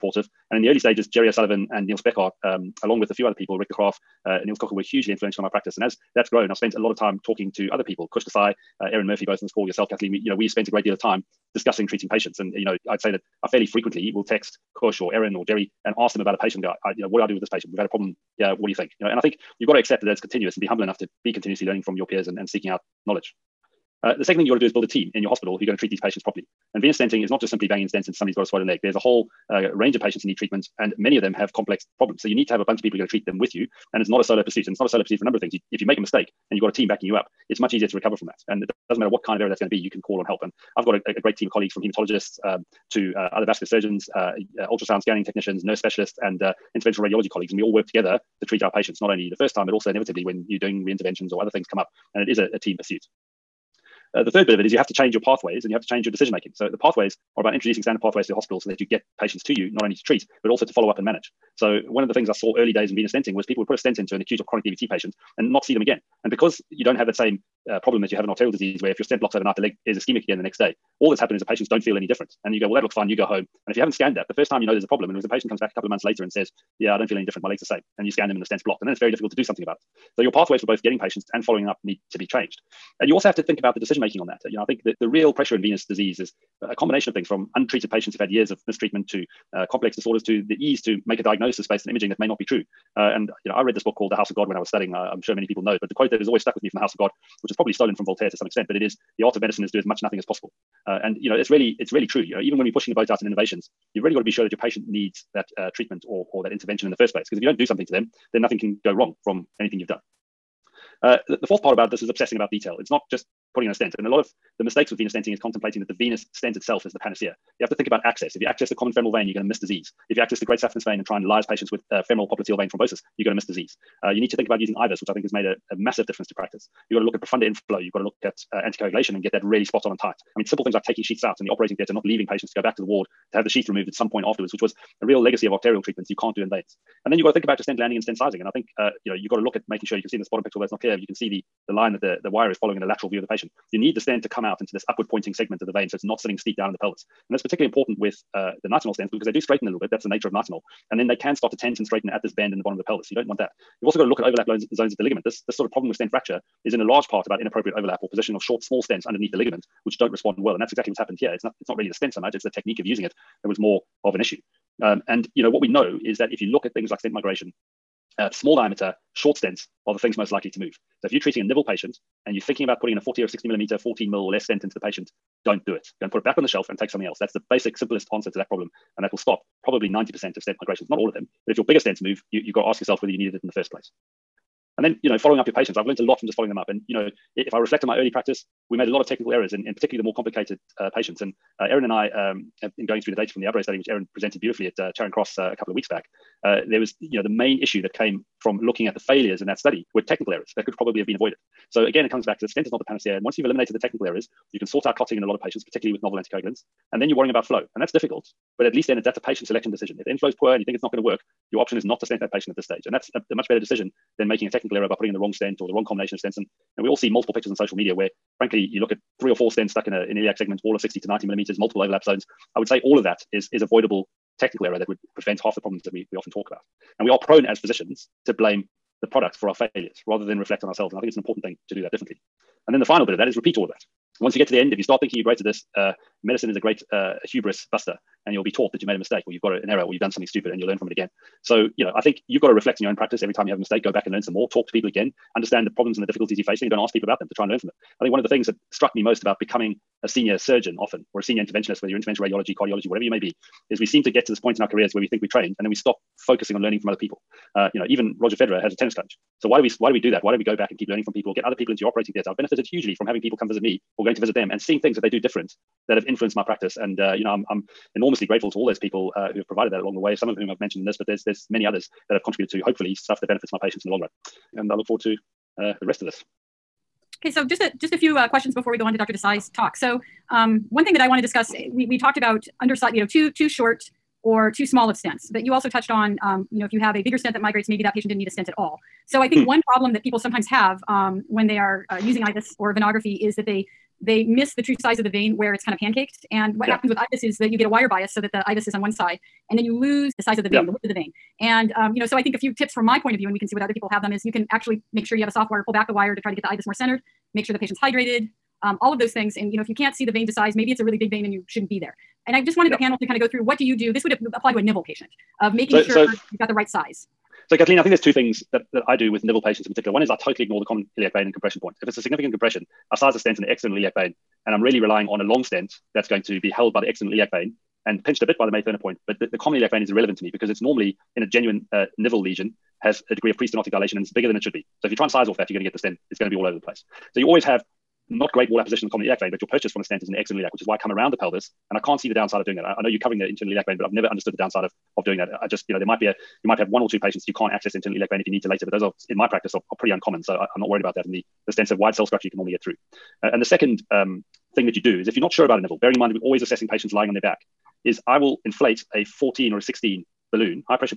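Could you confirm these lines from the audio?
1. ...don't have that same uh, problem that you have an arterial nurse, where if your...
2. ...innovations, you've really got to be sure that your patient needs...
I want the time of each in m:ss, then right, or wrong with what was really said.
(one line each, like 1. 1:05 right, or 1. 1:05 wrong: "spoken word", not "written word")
1. 1:06 wrong: "disease", not "nurse"
2. 1:43 right.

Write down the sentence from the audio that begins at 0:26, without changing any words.
And venous stenting is not just simply banging stents into somebody who's got a swollen leg.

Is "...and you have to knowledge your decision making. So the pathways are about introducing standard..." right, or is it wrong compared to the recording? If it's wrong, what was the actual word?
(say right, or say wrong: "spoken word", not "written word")
wrong: "change", not "knowledge".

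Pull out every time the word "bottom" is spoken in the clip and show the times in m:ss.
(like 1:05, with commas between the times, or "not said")
2:20, 2:32.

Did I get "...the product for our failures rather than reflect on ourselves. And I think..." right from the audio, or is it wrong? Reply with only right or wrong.
right.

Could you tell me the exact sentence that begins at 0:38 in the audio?
And it doesn't matter what kind of error that's going to be, you can call on help.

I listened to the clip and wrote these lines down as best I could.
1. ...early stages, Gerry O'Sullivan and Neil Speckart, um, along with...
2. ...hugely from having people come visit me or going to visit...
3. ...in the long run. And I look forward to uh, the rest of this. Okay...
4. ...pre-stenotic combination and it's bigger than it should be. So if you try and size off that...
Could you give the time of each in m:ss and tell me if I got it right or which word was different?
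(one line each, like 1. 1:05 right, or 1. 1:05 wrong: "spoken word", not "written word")
1. 0:00 right
2. 4:22 right
3. 4:33 right
4. 5:33 wrong: "dilation", not "combination".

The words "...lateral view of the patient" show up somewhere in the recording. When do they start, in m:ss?
2:22.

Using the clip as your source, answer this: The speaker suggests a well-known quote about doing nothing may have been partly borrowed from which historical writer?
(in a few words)
Voltaire.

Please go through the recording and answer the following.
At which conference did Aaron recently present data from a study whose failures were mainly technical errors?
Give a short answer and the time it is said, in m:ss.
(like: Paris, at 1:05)
Charing Cross, at 3:14.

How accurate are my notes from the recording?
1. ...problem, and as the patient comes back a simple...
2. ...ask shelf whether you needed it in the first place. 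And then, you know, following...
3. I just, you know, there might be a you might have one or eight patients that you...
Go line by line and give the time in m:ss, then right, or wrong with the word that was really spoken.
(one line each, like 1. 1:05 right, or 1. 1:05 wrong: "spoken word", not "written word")
1. 1:14 wrong: "couple", not "simple"
2. 3:02 wrong: "yourself", not "shelf"
3. 5:45 wrong: "two", not "eight".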